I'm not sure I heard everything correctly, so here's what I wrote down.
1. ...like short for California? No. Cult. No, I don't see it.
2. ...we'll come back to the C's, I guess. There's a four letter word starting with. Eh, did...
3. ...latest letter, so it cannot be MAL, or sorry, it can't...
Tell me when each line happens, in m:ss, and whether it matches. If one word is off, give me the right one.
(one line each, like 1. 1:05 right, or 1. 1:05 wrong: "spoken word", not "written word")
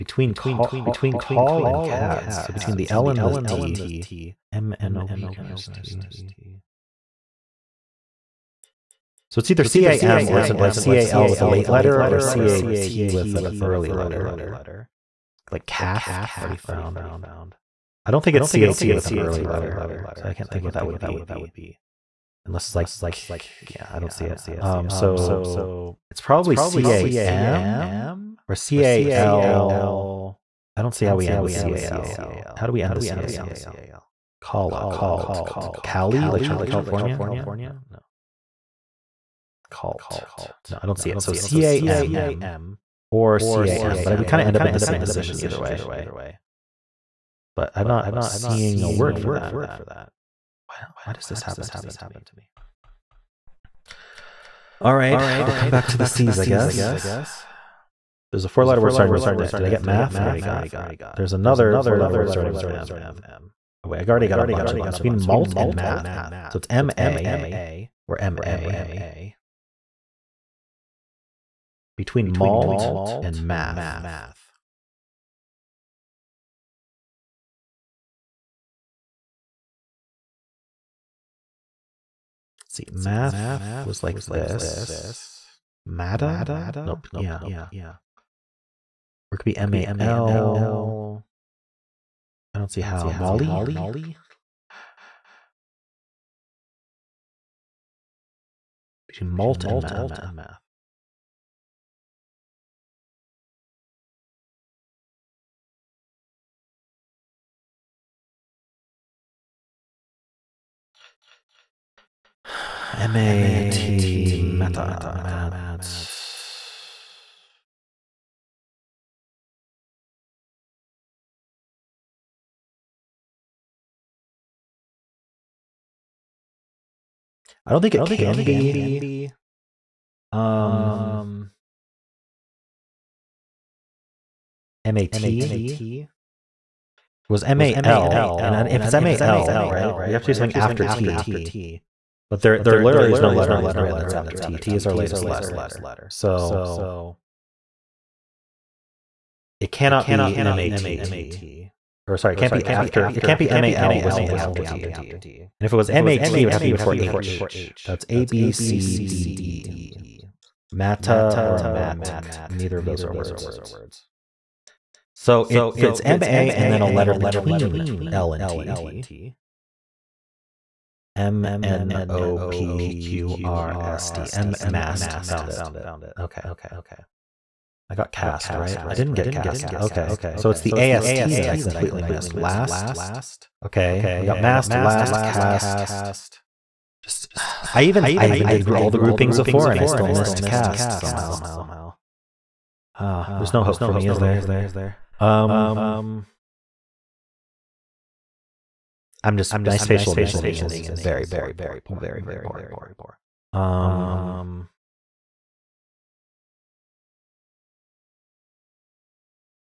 1. 0:36 right
2. 0:55 right
3. 2:24 wrong: "MAT", not "MAL".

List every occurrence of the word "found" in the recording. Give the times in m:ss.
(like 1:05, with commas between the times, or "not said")
0:16, 2:55.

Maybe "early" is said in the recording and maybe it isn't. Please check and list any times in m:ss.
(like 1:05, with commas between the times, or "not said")
0:13, 0:19.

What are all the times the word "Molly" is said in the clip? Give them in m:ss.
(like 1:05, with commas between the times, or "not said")
1:33.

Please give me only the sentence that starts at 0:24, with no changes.
Um, so it's probably C A M or C don't see how we end with CAL.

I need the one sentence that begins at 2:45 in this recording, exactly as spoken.
So it, it's MA and then a letter between L and T.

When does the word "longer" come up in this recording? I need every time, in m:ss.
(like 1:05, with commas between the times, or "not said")
not said.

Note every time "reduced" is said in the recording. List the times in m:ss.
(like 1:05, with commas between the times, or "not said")
not said.